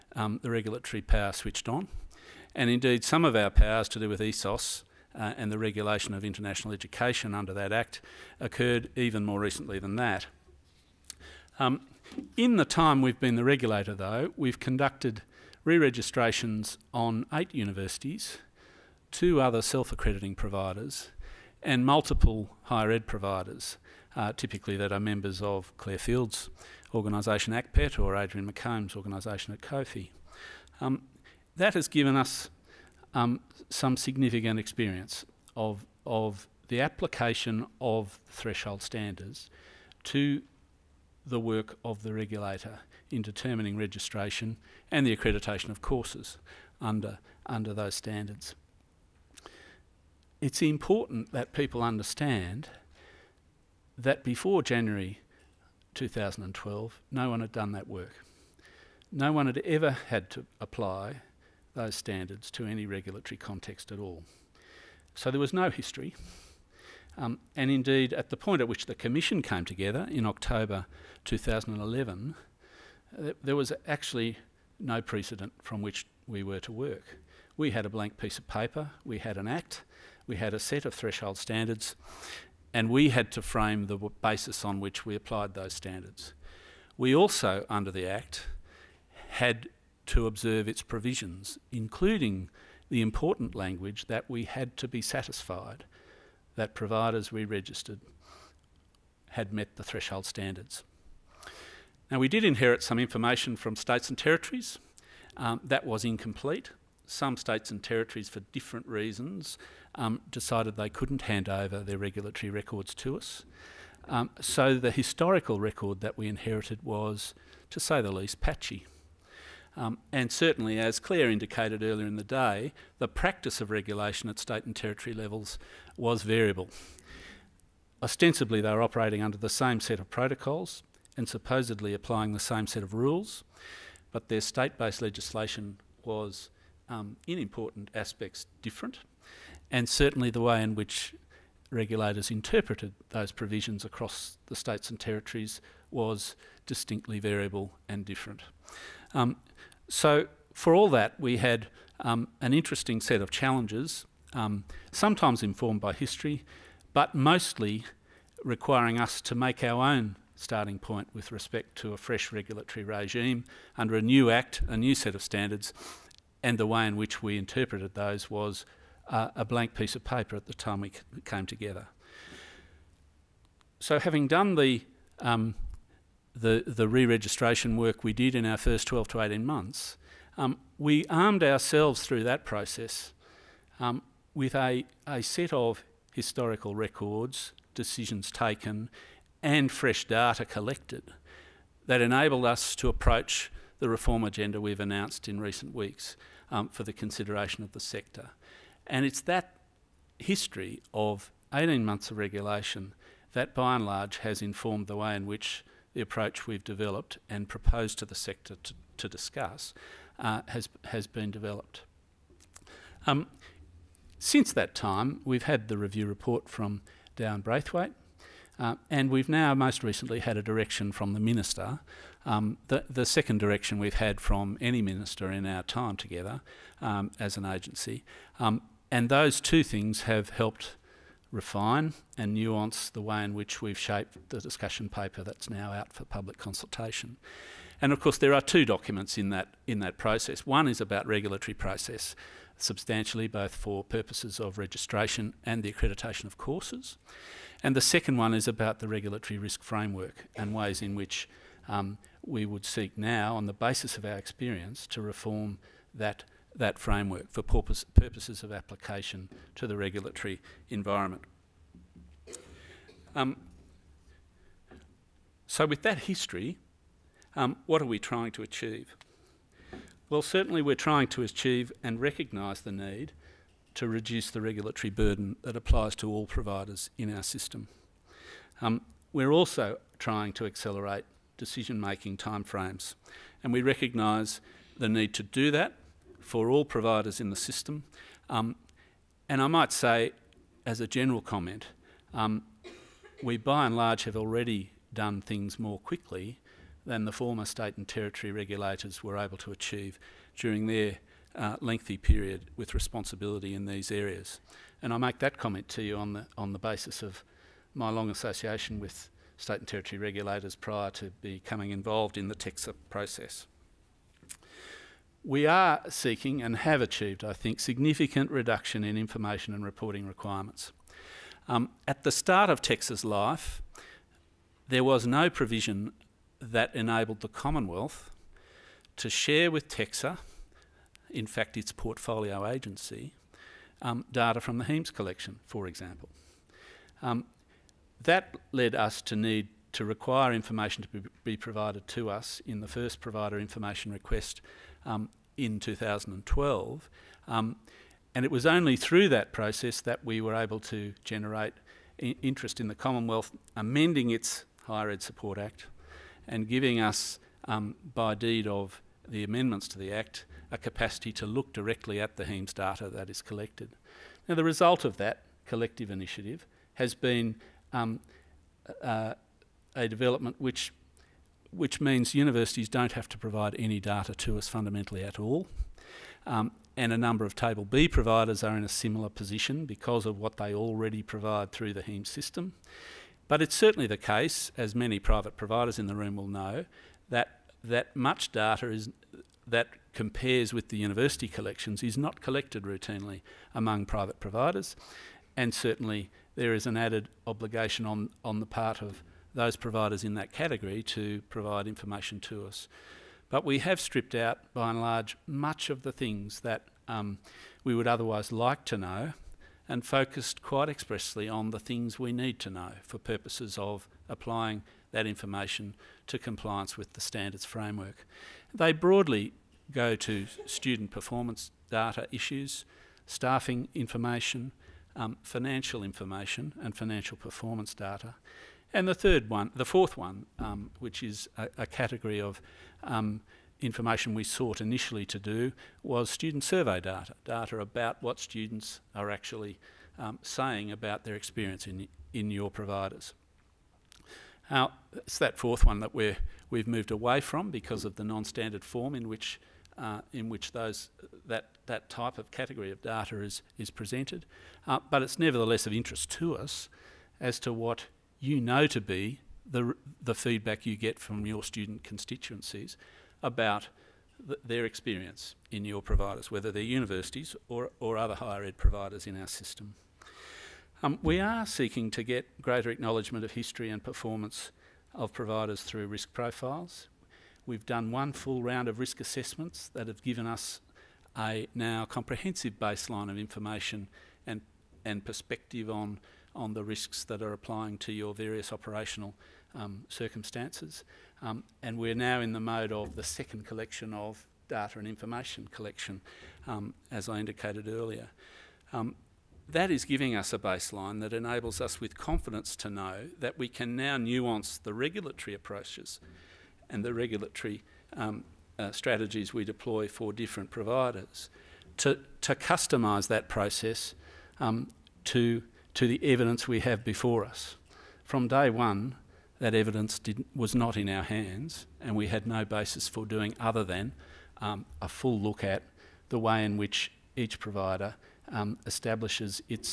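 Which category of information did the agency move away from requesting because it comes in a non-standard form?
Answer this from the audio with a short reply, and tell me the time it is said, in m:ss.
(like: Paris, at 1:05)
student survey data, at 7:16.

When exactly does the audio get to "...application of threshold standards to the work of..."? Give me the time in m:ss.
0:36.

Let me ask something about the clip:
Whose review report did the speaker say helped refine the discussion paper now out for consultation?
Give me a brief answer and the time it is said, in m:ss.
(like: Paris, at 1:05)
Dow Braithwaite, at 3:37.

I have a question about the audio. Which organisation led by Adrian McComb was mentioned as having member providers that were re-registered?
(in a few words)
COPHE.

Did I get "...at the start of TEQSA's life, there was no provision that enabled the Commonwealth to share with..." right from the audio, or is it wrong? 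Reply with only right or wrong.
right.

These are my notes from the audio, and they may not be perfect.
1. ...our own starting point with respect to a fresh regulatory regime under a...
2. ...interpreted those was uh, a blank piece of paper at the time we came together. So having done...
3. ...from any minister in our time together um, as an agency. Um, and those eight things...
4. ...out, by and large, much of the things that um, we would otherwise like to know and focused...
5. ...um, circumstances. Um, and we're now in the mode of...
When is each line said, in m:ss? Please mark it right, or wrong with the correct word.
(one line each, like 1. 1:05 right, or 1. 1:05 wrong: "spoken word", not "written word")
1. 2:39 right
2. 2:47 right
3. 3:44 wrong: "two", not "eight"
4. 6:44 right
5. 8:09 right.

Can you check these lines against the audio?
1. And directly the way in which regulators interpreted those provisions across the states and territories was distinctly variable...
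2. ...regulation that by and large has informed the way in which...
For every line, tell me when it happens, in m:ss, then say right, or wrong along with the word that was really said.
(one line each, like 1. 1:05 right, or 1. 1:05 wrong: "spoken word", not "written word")
1. 2:19 wrong: "certainly", not "directly"
2. 3:22 right.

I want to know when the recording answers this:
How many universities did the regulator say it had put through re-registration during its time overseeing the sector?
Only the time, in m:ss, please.
0:17.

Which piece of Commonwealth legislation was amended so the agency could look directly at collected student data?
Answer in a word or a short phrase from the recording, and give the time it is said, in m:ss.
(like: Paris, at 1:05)
Higher Ed Support Act, at 5:54.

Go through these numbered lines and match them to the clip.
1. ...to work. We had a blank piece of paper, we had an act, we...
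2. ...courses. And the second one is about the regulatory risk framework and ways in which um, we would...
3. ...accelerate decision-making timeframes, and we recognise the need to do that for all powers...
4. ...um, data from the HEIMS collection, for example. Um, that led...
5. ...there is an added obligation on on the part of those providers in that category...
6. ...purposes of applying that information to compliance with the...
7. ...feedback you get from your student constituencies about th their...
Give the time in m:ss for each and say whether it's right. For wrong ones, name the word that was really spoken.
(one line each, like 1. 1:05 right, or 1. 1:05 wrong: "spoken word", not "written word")
1. 1:16 right
2. 4:06 right
3. 4:40 wrong: "providers", not "powers"
4. 5:33 right
5. 6:36 right
6. 6:52 right
7. 7:40 right.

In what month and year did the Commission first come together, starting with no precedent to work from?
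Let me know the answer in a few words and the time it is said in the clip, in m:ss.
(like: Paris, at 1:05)
October 2011, at 1:10.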